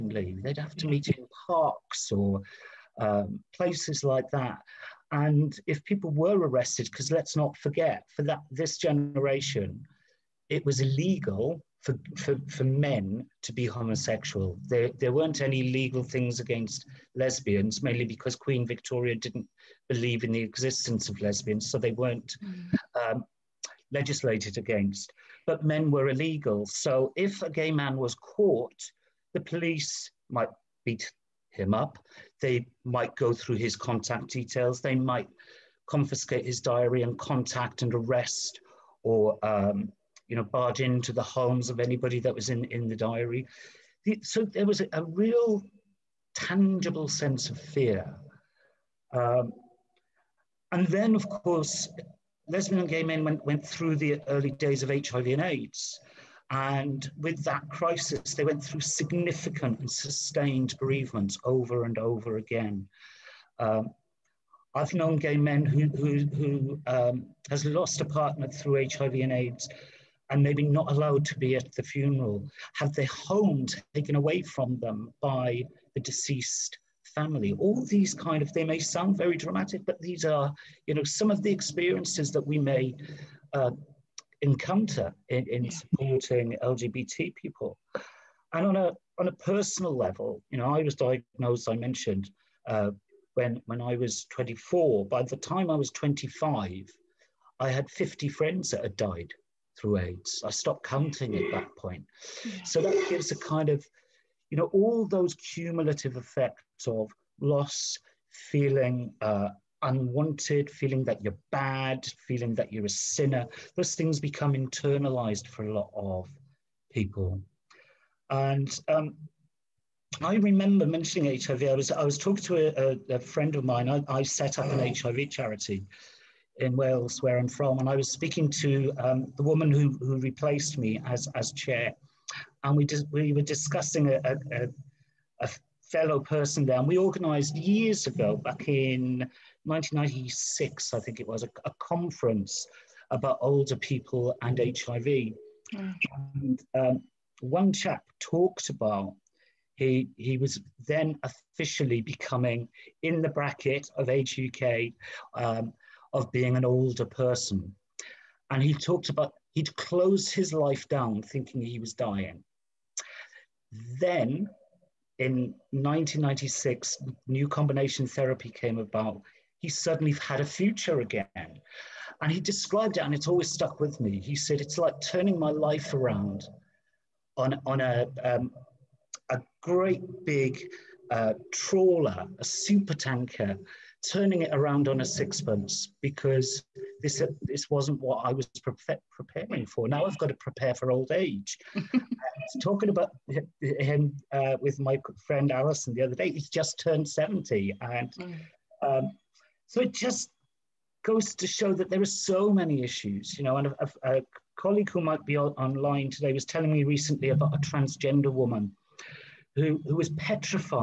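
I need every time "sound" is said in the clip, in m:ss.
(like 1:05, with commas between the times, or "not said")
1:18.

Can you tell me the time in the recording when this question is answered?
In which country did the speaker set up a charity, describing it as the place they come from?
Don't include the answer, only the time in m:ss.
2:06.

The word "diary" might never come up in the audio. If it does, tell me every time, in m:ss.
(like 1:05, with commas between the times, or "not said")
0:36, 0:42.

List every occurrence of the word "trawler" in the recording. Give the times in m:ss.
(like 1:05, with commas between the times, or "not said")
3:01.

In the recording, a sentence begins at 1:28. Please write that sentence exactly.
And on a, on a personal level, you know, I was diagnosed, I mentioned, uh, when, when I was 24.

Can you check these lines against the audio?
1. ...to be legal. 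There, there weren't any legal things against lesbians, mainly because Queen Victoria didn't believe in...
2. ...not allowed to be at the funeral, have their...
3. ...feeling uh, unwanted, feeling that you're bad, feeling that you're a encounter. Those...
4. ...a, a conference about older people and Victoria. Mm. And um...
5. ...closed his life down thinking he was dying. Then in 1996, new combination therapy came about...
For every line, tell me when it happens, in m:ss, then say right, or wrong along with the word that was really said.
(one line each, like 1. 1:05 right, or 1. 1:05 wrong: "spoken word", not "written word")
1. 0:13 wrong: "homosexual", not "legal"
2. 1:10 right
3. 1:48 wrong: "sinner", not "encounter"
4. 2:21 wrong: "HIV", not "Victoria"
5. 2:39 right.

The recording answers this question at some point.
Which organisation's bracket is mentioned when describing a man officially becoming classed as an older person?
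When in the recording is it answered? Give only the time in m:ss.
2:34.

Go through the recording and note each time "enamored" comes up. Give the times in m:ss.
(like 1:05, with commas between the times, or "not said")
not said.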